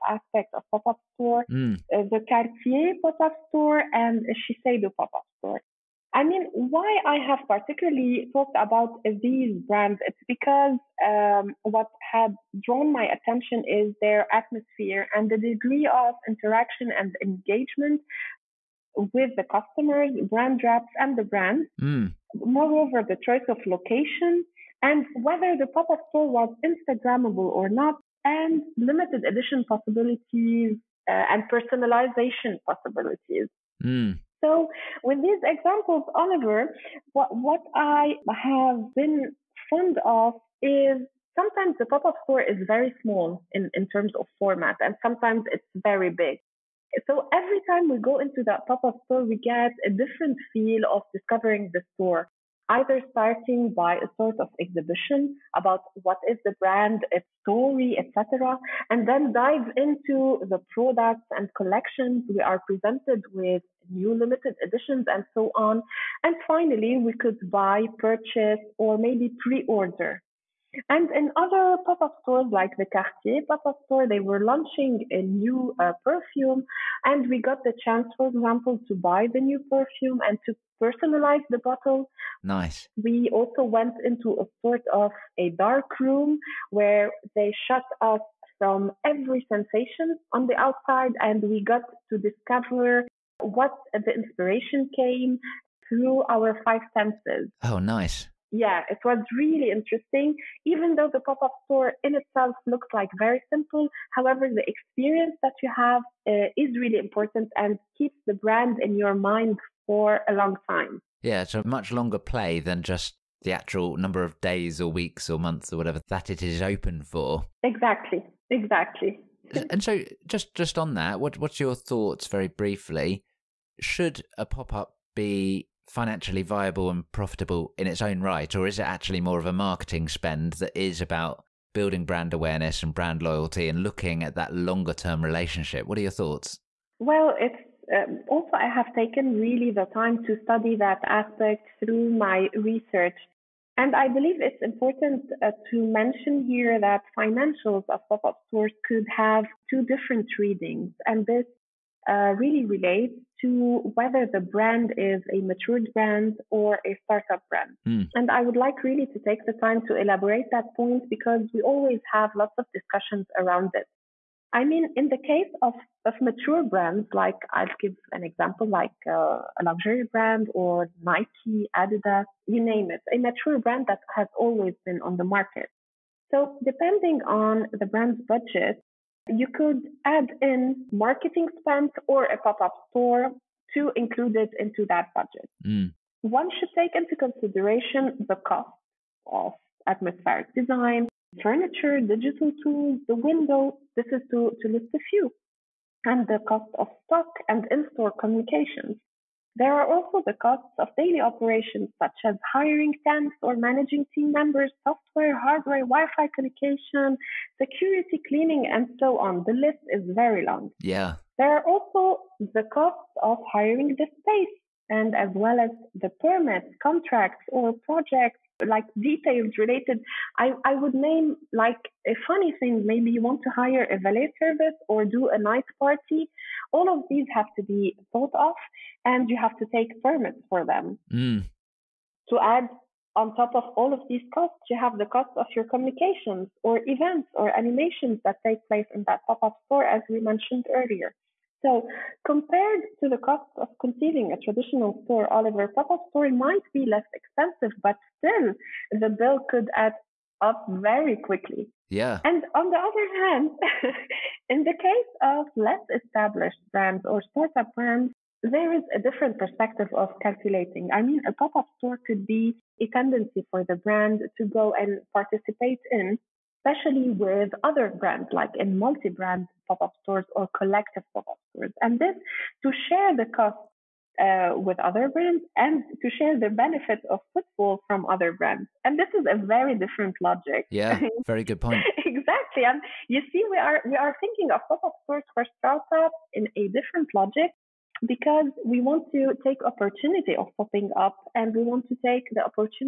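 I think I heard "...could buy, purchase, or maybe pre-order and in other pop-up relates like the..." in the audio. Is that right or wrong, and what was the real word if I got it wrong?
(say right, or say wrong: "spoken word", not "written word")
wrong: "stores", not "relates".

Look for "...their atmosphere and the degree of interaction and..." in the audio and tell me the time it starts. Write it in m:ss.
0:14.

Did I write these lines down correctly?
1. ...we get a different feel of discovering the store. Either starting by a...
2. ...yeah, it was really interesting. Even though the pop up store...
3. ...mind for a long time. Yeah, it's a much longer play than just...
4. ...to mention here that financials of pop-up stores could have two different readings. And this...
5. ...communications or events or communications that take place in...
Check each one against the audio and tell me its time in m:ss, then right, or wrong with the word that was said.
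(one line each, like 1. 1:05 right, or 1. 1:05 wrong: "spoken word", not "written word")
1. 0:49 right
2. 1:38 right
3. 1:49 right
4. 2:25 right
5. 3:55 wrong: "animations", not "communications".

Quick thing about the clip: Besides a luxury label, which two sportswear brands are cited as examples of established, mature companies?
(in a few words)
Nike, Adidas.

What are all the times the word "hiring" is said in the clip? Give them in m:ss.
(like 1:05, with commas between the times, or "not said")
3:22, 3:33.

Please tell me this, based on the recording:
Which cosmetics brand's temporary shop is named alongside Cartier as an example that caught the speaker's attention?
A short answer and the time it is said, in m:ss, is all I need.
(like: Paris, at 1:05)
Shiseido, at 0:04.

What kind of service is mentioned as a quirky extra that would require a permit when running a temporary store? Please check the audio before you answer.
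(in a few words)
valet service.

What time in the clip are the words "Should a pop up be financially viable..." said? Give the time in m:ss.
2:03.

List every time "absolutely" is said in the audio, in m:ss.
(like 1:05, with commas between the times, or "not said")
not said.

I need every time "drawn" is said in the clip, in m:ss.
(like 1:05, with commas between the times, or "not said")
0:12.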